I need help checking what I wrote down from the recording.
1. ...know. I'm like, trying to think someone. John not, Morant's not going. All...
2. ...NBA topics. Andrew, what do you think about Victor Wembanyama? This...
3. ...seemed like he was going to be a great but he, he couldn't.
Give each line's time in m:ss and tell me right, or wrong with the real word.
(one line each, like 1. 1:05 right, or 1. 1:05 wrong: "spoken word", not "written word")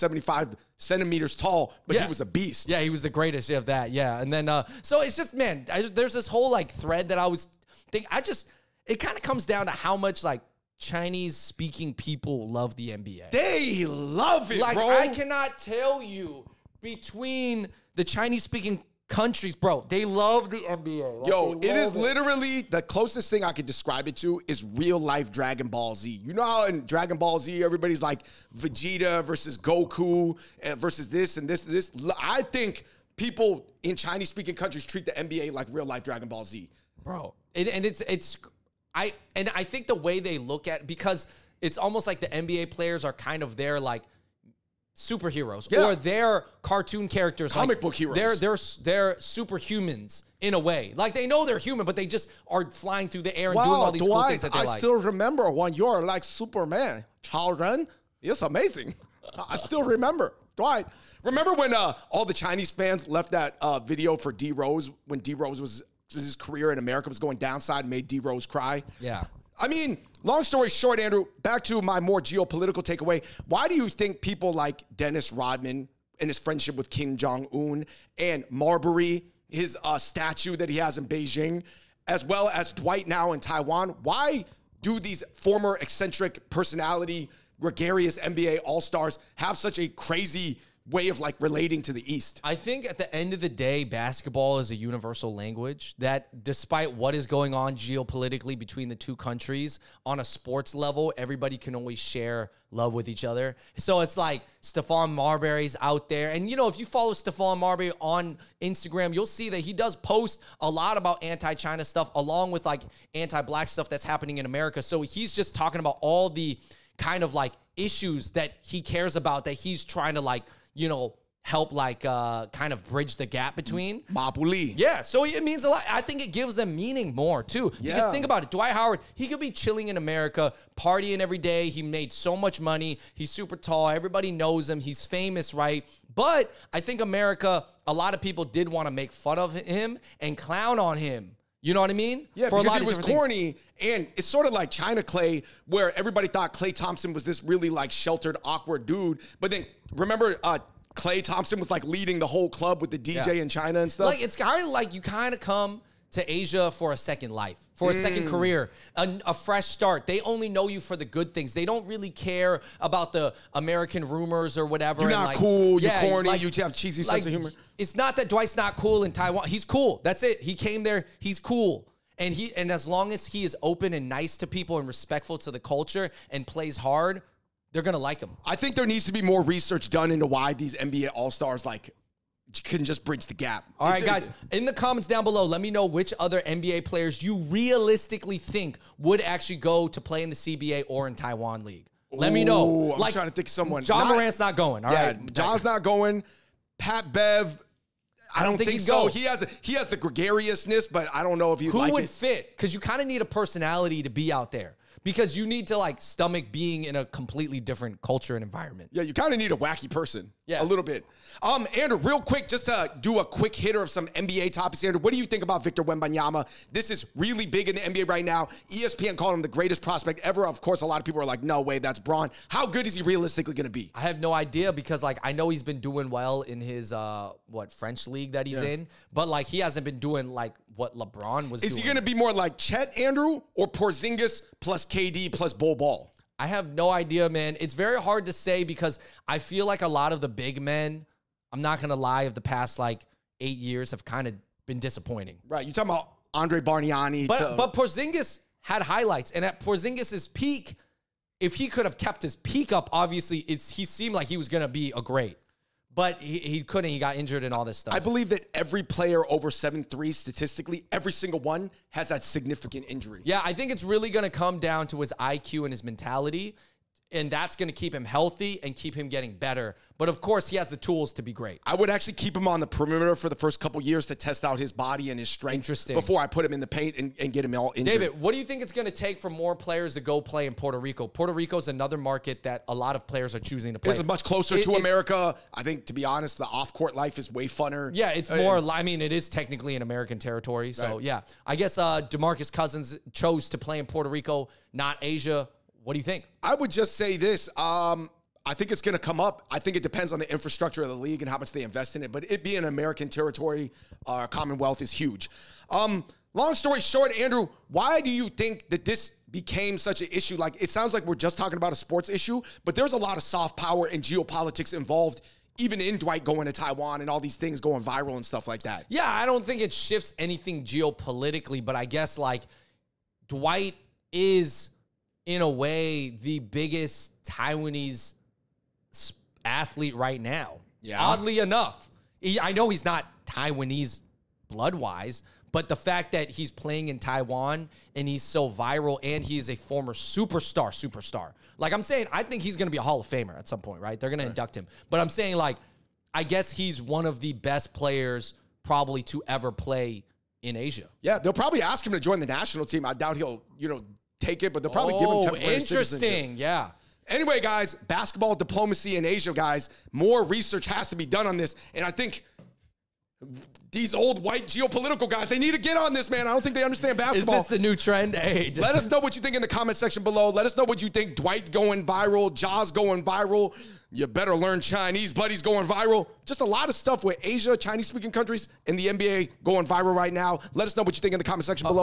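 1. 3:12 right
2. 3:34 right
3. 4:13 right.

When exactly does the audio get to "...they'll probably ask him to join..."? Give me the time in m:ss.
5:51.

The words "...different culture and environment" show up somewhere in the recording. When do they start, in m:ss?
3:27.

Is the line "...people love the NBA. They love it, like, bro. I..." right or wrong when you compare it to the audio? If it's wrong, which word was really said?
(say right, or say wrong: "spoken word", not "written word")
right.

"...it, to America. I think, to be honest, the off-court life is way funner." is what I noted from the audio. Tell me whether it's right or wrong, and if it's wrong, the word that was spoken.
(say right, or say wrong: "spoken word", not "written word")
right.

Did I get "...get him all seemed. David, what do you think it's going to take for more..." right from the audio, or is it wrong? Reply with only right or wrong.
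wrong.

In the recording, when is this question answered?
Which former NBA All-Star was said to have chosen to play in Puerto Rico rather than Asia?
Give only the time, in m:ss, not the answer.
4:52.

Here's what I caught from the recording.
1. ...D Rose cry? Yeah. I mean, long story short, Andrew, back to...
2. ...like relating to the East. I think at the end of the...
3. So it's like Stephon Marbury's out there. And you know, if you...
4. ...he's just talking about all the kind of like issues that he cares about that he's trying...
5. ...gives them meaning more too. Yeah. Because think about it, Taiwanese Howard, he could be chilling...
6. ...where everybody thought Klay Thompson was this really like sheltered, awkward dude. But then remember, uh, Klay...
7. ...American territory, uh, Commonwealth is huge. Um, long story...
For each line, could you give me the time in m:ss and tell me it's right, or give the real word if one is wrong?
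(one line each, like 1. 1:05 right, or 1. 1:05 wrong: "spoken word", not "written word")
1. 1:08 right
2. 1:31 right
3. 1:43 right
4. 1:55 right
5. 2:06 wrong: "Dwight", not "Taiwanese"
6. 2:25 right
7. 5:02 right.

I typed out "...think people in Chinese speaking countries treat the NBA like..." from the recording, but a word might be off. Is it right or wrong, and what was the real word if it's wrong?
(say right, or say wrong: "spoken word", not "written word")
right.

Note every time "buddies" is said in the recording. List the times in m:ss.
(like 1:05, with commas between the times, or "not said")
6:15.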